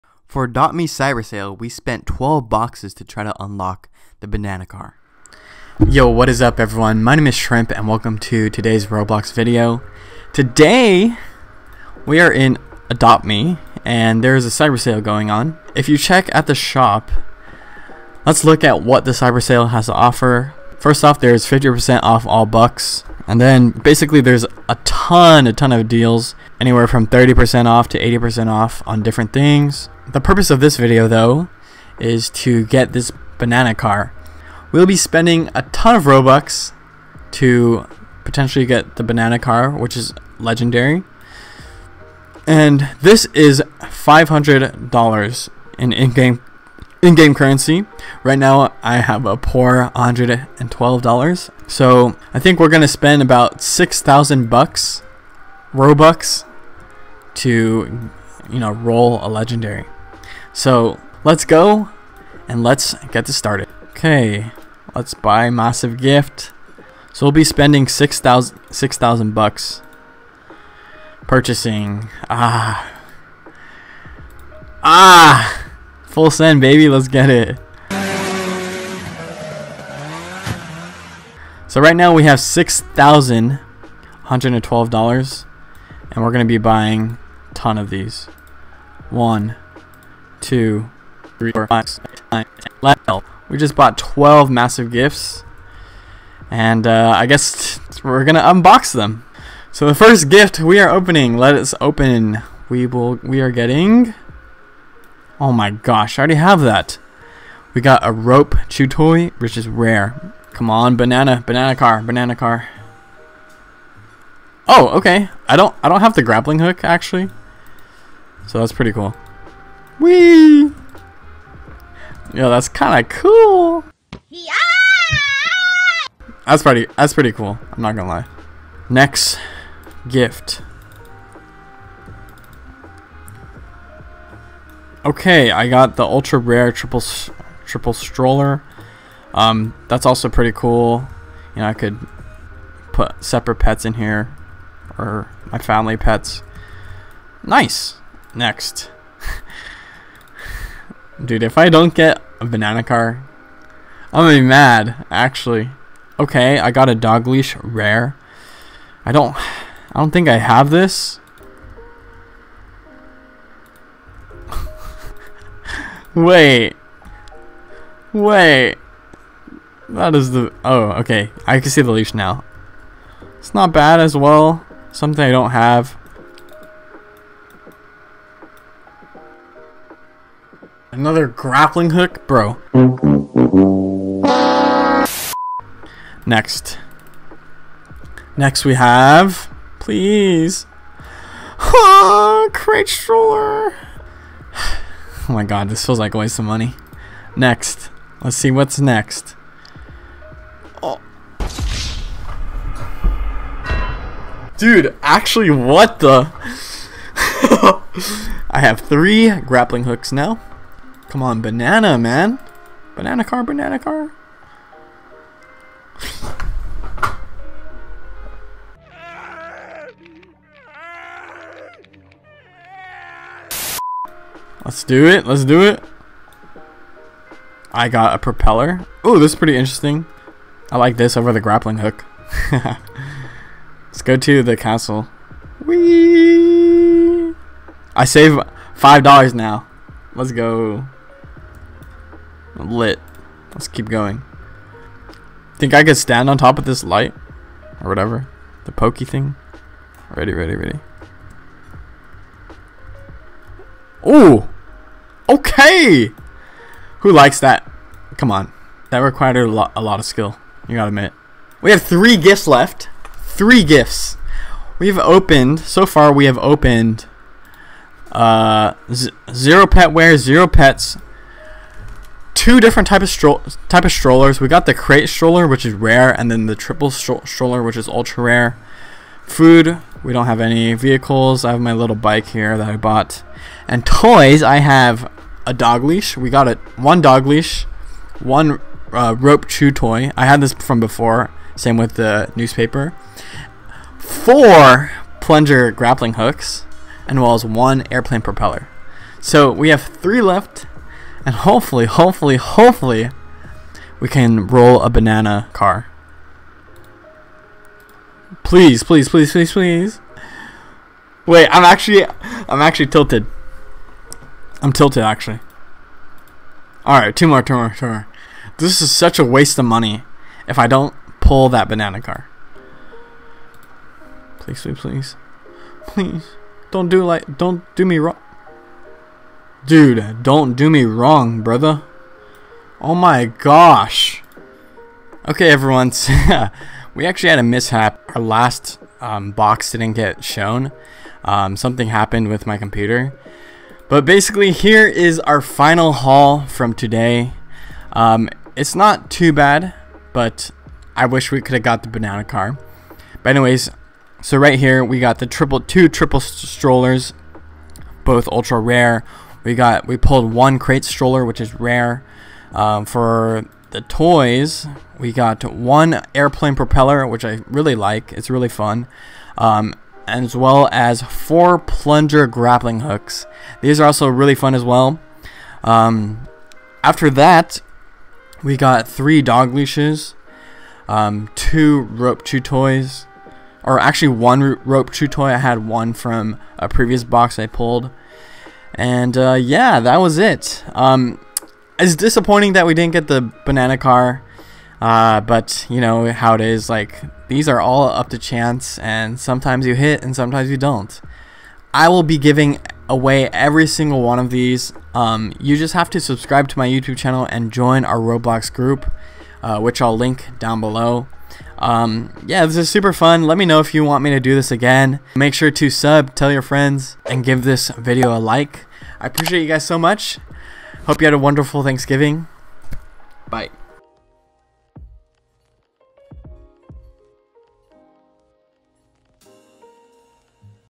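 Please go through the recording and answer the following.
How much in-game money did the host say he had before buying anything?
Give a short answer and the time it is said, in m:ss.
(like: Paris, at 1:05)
$112, at 0:49.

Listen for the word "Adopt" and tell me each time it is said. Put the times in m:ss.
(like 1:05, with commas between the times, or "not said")
0:12.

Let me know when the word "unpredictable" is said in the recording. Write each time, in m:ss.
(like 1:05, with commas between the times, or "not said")
not said.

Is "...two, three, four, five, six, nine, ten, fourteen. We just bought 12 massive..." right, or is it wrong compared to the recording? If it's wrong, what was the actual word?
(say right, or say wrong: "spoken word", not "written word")
wrong: "eleven", not "fourteen".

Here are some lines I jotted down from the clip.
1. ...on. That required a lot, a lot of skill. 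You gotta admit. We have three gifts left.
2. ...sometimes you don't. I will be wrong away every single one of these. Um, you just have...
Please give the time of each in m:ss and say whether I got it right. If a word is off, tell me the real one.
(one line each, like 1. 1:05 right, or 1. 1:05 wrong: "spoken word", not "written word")
1. 4:18 right
2. 6:40 wrong: "giving", not "wrong".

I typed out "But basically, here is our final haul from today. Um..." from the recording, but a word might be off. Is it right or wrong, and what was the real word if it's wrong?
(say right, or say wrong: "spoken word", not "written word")
right.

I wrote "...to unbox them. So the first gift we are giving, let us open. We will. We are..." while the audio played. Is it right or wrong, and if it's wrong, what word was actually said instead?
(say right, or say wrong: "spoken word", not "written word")
wrong: "opening", not "giving".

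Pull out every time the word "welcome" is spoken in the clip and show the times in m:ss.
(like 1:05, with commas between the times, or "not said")
0:07.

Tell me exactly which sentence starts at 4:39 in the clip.
Food, we don't have any vehicles.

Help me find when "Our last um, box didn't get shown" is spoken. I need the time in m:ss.
5:38.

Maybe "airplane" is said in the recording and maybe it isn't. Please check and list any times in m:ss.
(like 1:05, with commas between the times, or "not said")
4:57, 6:06.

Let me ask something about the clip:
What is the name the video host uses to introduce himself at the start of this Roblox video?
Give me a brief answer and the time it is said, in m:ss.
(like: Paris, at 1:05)
Shrimp, at 0:07.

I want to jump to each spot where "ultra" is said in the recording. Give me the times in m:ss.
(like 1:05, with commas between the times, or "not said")
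2:16, 4:37, 5:58.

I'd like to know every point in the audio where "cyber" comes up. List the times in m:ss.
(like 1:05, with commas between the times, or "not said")
0:00, 0:14, 0:19.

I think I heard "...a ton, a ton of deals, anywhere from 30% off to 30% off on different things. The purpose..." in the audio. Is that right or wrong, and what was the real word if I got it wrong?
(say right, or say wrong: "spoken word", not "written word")
wrong: "80", not "30".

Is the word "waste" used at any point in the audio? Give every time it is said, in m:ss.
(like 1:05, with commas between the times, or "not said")
3:16, 5:19.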